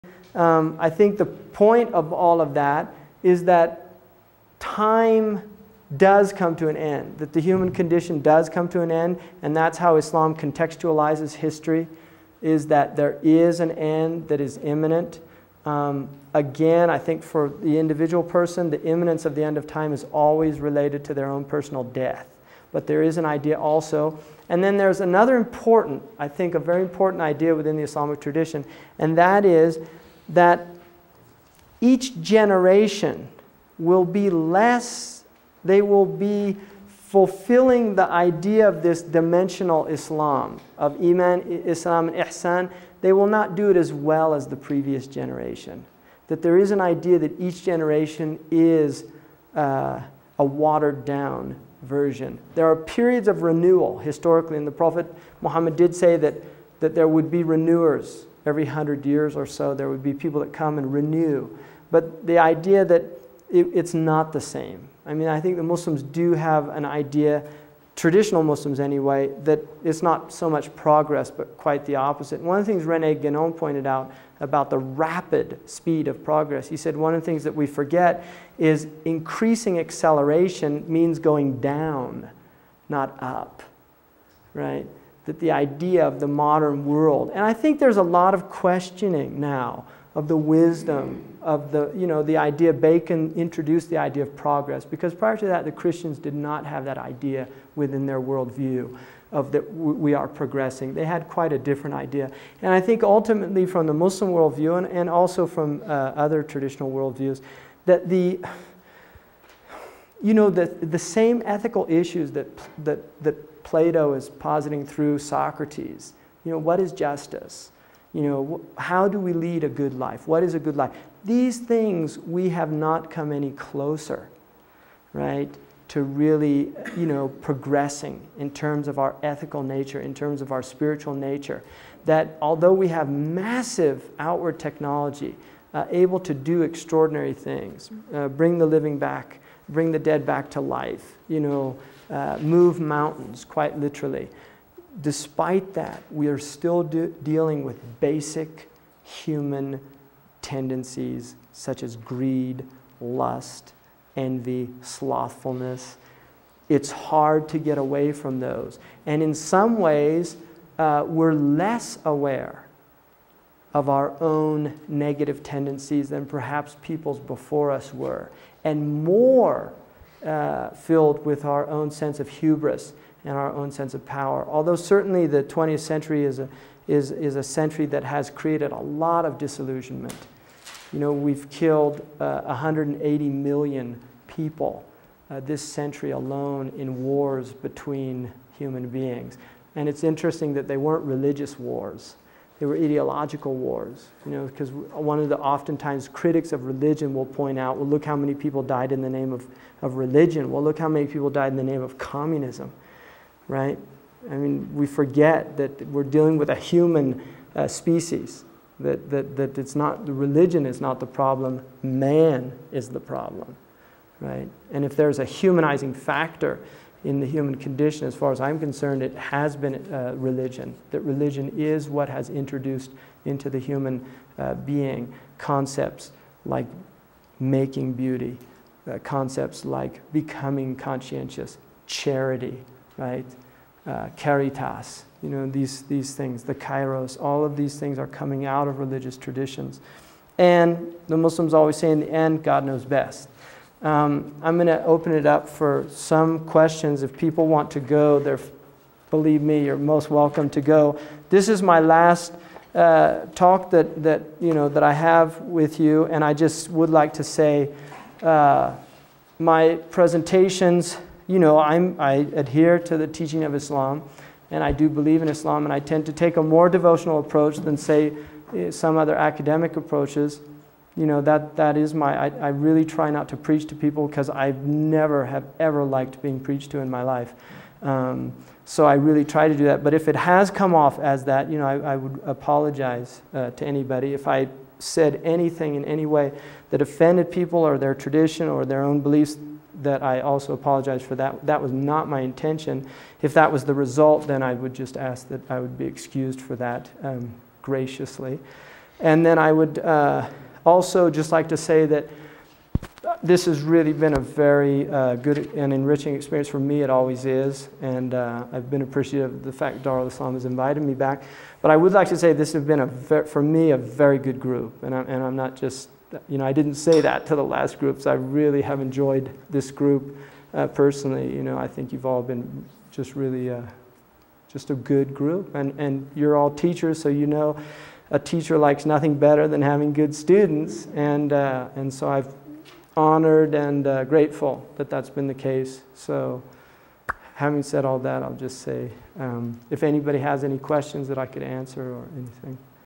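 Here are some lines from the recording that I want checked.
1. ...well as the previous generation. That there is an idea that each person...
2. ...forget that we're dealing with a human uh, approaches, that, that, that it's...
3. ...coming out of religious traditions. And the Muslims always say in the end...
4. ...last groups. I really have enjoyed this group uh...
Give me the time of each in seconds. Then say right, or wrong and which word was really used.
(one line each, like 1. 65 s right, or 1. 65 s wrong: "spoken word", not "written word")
1. 43 s wrong: "generation", not "person"
2. 204 s wrong: "species", not "approaches"
3. 238 s right
4. 317 s right.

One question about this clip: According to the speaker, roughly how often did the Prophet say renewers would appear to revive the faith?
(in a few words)
every 100 years.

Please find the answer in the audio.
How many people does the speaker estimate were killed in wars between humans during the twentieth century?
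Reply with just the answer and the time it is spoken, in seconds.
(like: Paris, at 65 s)
180 million, at 182 s.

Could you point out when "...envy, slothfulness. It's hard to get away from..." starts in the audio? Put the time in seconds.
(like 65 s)
154 s.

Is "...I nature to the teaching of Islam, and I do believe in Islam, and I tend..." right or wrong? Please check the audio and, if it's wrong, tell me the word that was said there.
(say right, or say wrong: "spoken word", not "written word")
wrong: "adhere", not "nature".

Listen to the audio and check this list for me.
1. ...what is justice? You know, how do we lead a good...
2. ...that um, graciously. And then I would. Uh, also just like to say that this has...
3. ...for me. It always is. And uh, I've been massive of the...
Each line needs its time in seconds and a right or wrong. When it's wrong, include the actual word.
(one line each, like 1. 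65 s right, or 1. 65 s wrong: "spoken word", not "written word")
1. 116 s right
2. 296 s right
3. 306 s wrong: "appreciative", not "massive".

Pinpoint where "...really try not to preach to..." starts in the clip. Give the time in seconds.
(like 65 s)
272 s.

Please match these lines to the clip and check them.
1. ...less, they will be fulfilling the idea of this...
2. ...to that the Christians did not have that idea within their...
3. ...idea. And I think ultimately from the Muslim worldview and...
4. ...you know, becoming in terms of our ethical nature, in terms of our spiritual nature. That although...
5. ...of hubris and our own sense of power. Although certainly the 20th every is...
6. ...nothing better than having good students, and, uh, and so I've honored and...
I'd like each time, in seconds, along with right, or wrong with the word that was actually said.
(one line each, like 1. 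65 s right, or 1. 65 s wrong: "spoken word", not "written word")
1. 34 s right
2. 95 s right
3. 101 s right
4. 126 s wrong: "progressing", not "becoming"
5. 172 s wrong: "century", not "every"
6. 328 s right.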